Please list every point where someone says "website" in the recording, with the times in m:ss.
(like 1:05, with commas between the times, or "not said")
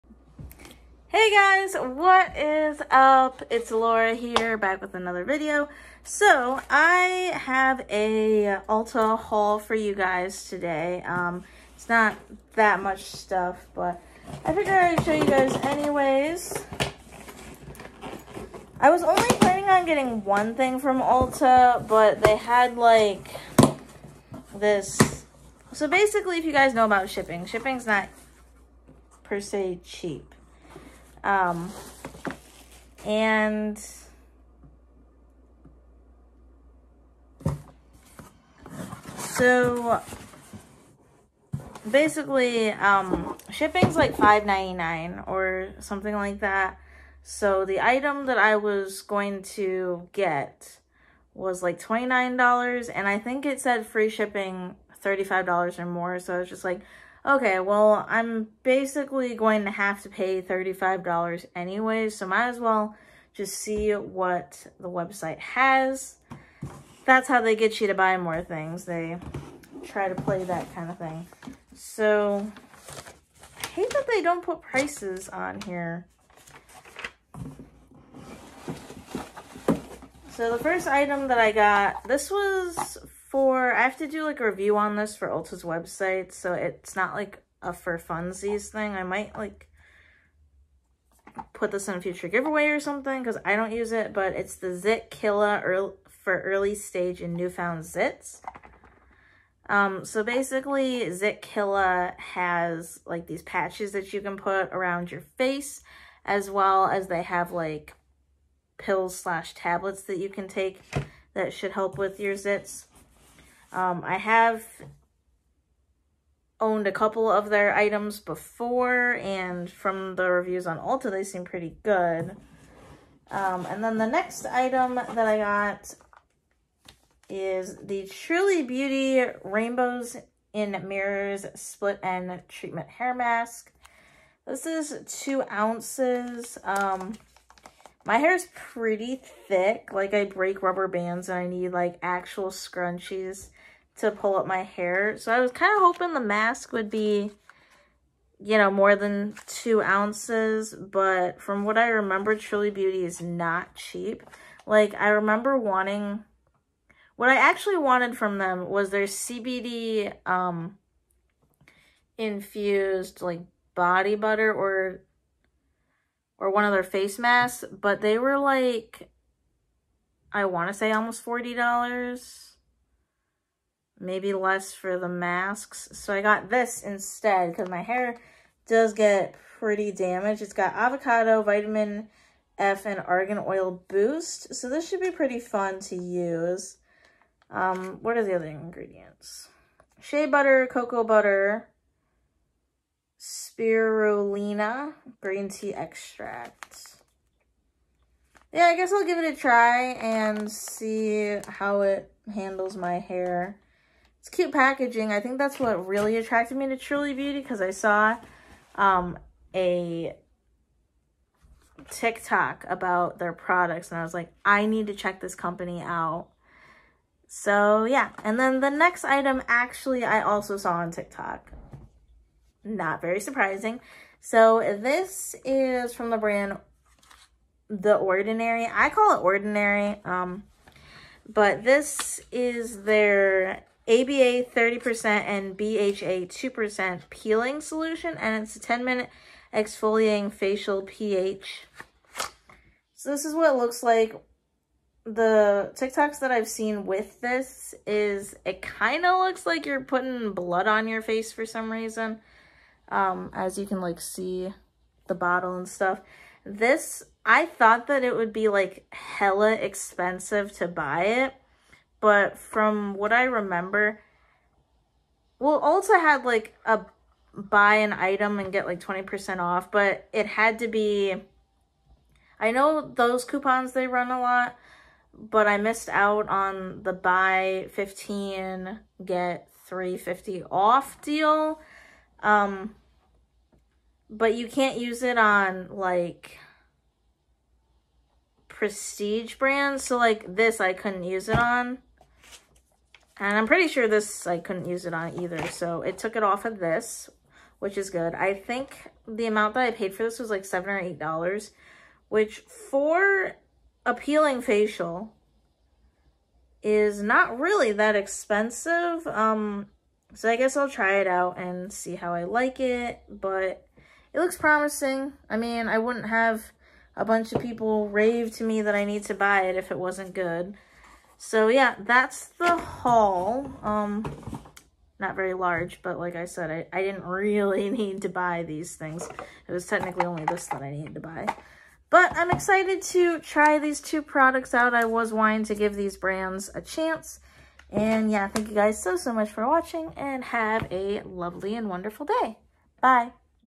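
1:04, 1:25.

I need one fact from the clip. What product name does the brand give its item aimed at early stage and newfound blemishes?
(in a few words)
Zit Killa.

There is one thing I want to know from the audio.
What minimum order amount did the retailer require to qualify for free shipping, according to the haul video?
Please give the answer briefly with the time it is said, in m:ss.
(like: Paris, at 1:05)
$35, at 0:53.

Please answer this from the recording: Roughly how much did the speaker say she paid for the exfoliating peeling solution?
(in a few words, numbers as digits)
$7 or $8.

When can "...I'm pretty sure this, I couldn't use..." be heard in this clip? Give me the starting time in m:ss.
4:53.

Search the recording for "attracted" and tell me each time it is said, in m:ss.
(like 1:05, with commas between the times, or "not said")
3:26.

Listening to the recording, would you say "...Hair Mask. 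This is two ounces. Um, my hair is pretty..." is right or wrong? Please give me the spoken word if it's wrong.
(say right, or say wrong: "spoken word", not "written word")
right.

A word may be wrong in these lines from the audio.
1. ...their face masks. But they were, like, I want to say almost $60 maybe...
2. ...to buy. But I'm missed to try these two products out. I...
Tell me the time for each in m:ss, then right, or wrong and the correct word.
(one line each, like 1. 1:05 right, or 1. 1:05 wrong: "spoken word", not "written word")
1. 2:46 wrong: "40", not "60"
2. 5:30 wrong: "excited", not "missed".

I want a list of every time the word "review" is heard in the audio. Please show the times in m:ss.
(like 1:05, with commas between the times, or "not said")
1:24, 2:00.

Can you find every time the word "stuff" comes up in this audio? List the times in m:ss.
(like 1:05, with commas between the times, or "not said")
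0:13, 4:15.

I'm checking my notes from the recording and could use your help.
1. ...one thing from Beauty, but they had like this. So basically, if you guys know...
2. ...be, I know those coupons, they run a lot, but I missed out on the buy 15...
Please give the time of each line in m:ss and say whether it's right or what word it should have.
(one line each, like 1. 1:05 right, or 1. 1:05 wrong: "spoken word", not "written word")
1. 0:20 wrong: "Ulta", not "Beauty"
2. 4:30 right.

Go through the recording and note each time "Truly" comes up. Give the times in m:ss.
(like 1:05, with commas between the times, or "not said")
2:08, 2:32, 3:26.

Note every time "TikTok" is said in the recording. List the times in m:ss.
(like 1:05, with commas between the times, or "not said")
3:31, 3:40, 4:05.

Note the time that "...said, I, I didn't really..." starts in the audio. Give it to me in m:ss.
5:26.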